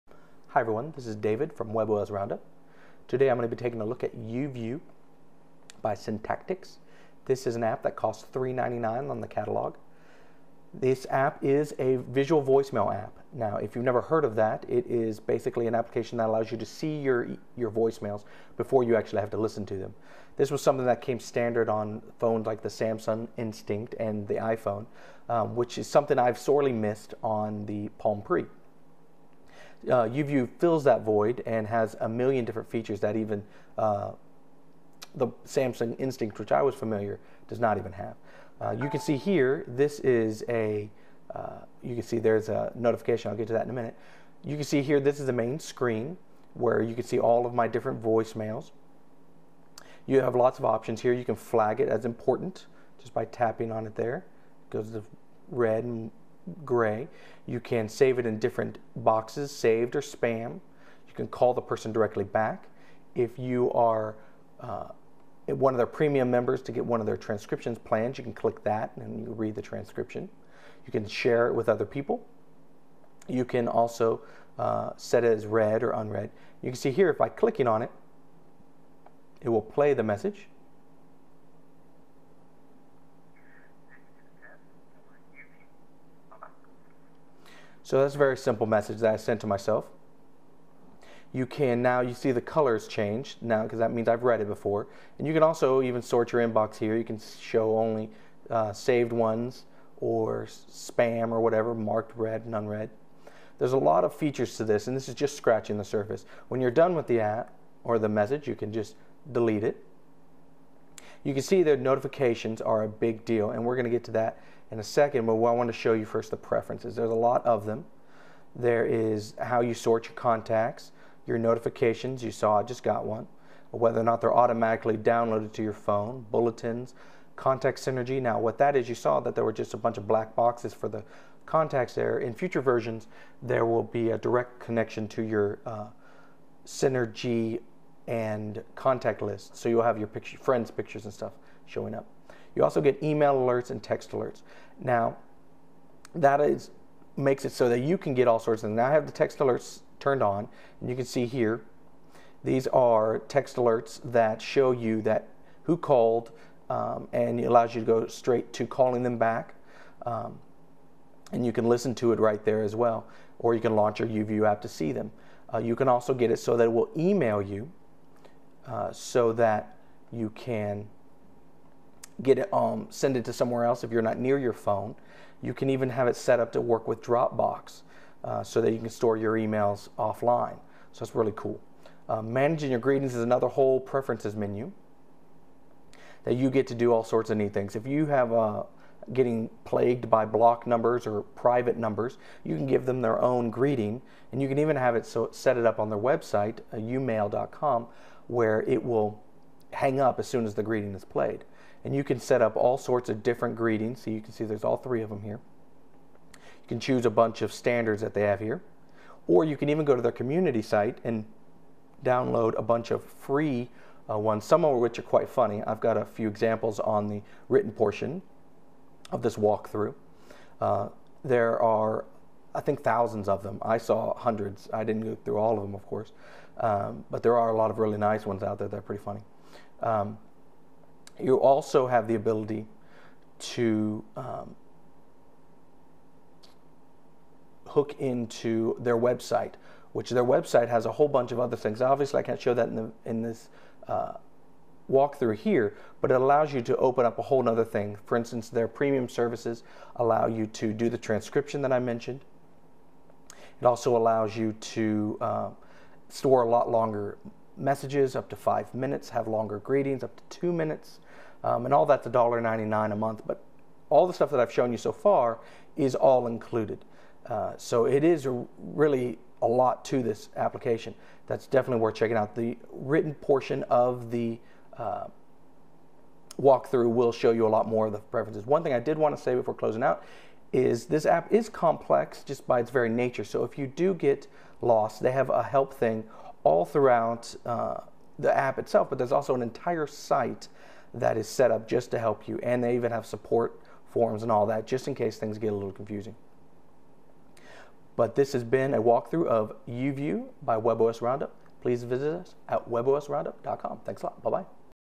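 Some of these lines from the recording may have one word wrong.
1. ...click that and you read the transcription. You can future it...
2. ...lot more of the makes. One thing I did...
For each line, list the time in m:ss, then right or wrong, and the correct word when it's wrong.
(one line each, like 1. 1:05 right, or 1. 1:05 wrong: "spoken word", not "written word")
1. 1:08 wrong: "share", not "future"
2. 4:37 wrong: "preferences", not "makes".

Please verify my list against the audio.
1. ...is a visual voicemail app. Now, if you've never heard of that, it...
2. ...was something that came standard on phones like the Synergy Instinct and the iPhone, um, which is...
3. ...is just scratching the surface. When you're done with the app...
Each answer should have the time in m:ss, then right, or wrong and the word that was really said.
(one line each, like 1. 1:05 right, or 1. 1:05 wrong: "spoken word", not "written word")
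1. 0:11 right
2. 0:20 wrong: "Samsung", not "Synergy"
3. 1:45 right.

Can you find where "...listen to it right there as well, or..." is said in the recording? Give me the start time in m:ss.
2:41.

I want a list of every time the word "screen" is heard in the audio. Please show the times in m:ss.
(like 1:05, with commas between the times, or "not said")
0:45.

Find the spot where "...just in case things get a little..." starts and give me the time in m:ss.
4:54.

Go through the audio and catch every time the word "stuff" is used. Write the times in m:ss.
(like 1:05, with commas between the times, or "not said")
2:21, 4:24.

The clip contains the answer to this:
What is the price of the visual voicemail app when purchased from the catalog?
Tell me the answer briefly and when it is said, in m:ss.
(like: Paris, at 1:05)
$3.99, at 0:08.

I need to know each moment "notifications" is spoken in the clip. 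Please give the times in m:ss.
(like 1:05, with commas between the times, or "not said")
0:42, 1:51, 2:01.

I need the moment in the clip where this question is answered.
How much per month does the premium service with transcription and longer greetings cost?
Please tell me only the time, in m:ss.
4:22.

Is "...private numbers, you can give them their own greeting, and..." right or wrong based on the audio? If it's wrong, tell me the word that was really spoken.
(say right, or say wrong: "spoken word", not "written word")
right.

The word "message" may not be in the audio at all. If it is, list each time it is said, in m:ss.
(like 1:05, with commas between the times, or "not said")
1:20, 1:28, 1:48, 4:17.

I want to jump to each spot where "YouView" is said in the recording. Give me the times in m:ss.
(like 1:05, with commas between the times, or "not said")
0:04, 0:30, 2:44, 4:59.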